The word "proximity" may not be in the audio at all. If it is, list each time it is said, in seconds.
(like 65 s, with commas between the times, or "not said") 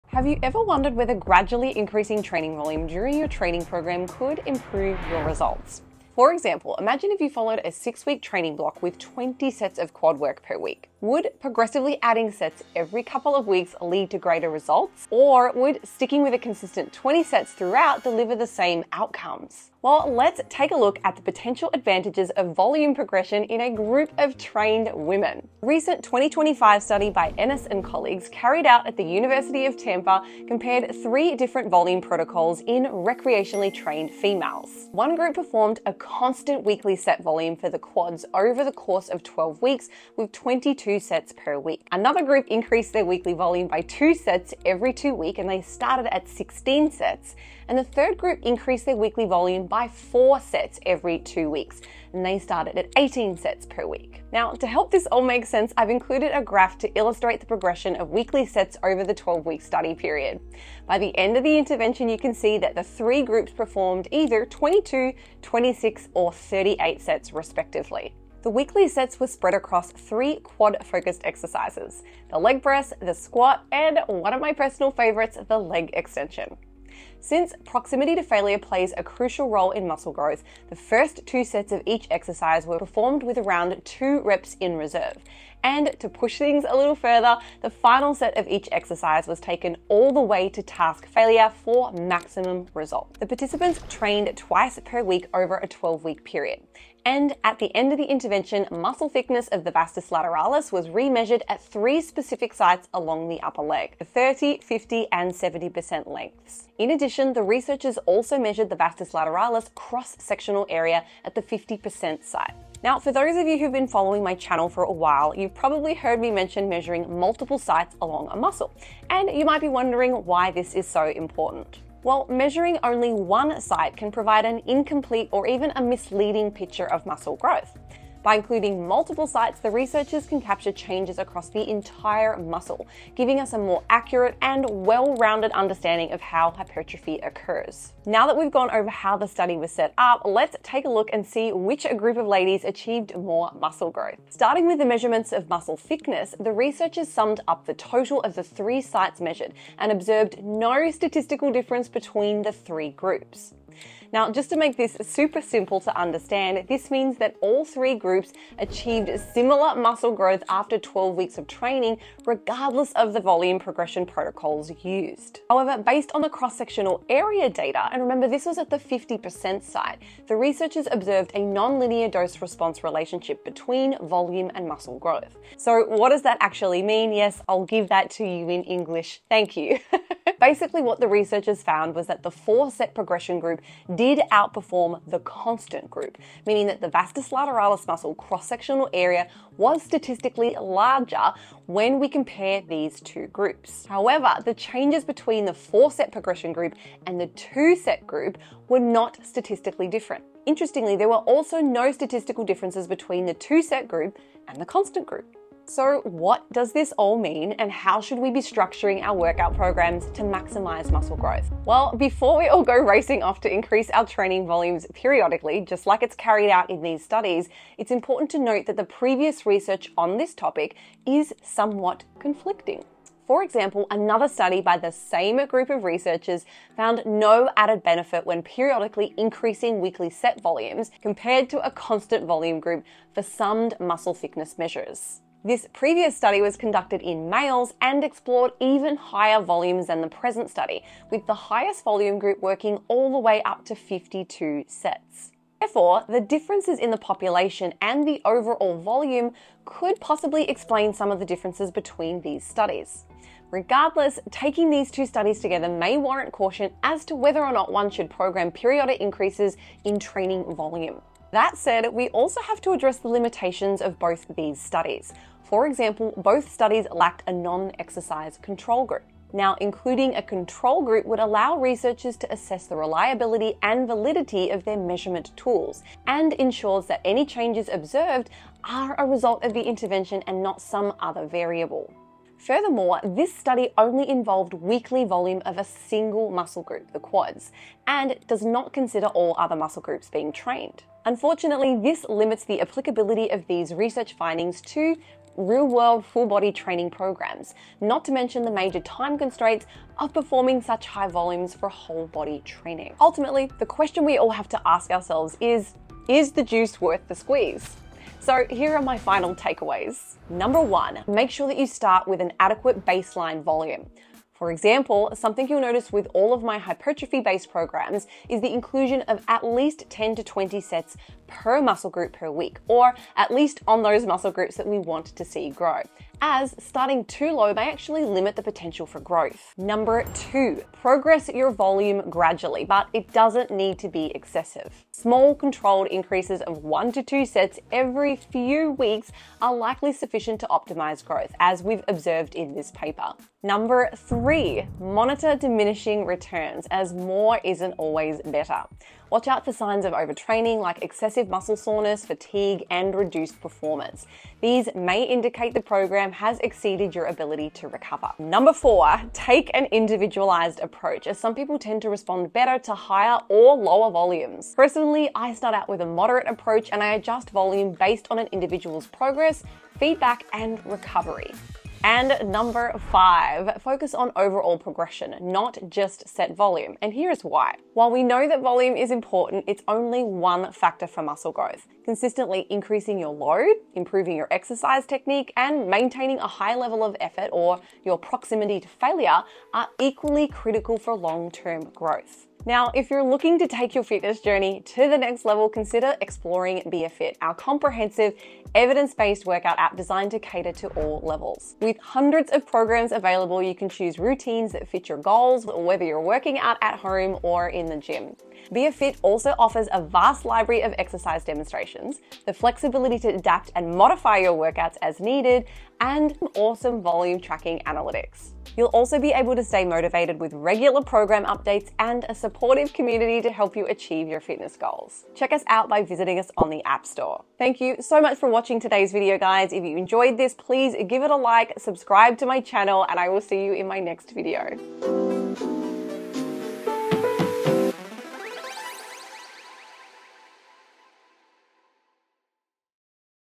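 77 s, 387 s.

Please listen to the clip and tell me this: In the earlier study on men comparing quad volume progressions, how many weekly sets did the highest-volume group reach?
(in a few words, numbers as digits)
52.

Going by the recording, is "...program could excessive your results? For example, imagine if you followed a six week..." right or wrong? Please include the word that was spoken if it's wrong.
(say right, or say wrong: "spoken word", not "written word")
wrong: "improve", not "excessive".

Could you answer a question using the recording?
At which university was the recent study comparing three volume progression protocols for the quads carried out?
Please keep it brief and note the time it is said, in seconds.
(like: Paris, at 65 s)
University of Tampa, at 29 s.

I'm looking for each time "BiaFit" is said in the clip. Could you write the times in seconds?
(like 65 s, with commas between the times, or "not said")
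396 s, 408 s.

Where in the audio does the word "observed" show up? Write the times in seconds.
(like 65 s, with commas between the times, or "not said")
149 s, 170 s, 277 s, 341 s.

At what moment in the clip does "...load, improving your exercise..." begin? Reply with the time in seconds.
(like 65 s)
383 s.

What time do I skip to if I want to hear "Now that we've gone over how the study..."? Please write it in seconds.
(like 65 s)
138 s.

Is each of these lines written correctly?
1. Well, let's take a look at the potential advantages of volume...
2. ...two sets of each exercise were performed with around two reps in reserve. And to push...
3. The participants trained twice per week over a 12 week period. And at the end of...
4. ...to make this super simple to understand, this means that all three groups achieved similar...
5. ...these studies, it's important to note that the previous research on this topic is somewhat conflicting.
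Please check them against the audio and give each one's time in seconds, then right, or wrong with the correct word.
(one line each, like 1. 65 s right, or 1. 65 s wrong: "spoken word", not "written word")
1. 19 s right
2. 81 s right
3. 93 s right
4. 154 s right
5. 216 s right.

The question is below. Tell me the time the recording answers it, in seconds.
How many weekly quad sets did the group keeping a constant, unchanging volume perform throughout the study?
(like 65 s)
40 s.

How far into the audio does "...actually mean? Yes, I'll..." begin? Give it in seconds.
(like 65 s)
176 s.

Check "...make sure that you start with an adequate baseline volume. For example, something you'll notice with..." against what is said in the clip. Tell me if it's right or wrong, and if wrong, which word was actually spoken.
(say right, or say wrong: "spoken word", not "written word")
right.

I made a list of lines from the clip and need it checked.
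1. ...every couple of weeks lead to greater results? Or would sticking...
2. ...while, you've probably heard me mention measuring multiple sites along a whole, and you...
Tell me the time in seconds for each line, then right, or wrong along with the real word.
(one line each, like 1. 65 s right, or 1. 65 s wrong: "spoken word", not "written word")
1. 12 s right
2. 114 s wrong: "muscle", not "whole".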